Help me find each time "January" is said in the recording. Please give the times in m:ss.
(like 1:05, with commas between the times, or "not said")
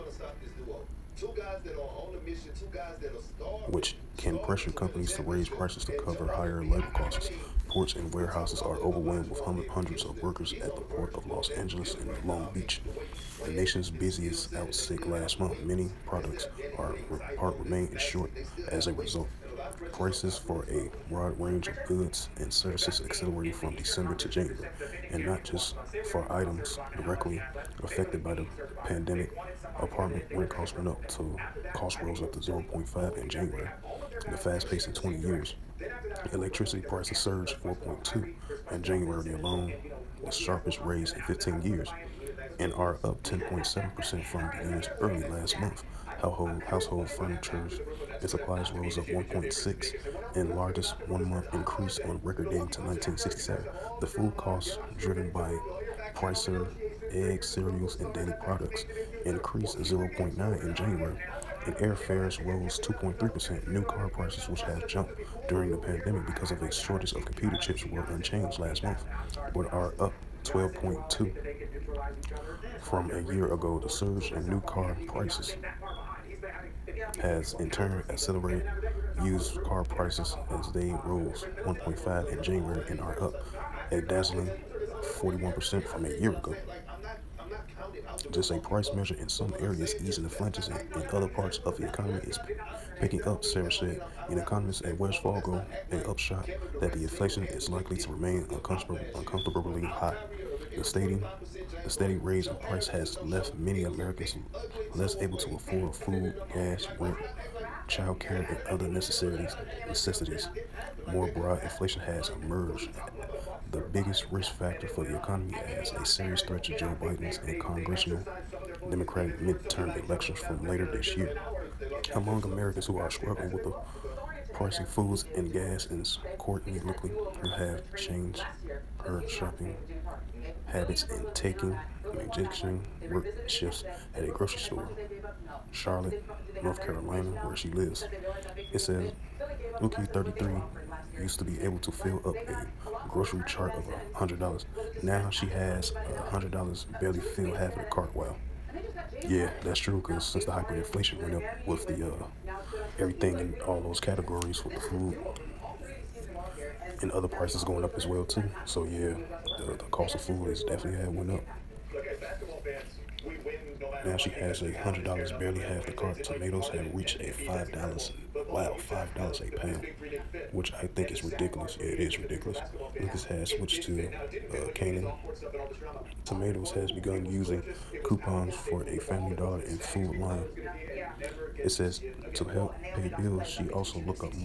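0:24, 0:33, 0:38, 1:00, 1:22.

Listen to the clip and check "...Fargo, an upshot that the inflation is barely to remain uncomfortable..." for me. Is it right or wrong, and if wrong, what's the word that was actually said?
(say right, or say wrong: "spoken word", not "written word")
wrong: "likely", not "barely".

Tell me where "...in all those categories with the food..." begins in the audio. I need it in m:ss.
2:33.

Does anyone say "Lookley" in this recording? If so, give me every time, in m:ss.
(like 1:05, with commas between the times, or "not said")
2:06.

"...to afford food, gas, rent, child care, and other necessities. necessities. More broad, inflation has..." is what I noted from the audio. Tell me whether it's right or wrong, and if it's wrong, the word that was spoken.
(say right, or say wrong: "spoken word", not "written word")
right.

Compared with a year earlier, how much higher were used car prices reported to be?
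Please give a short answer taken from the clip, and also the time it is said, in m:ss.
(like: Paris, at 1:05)
41%, at 1:25.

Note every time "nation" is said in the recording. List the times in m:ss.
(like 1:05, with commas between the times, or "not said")
0:13.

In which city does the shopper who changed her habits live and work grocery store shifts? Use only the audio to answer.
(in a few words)
Charlotte, North Carolina.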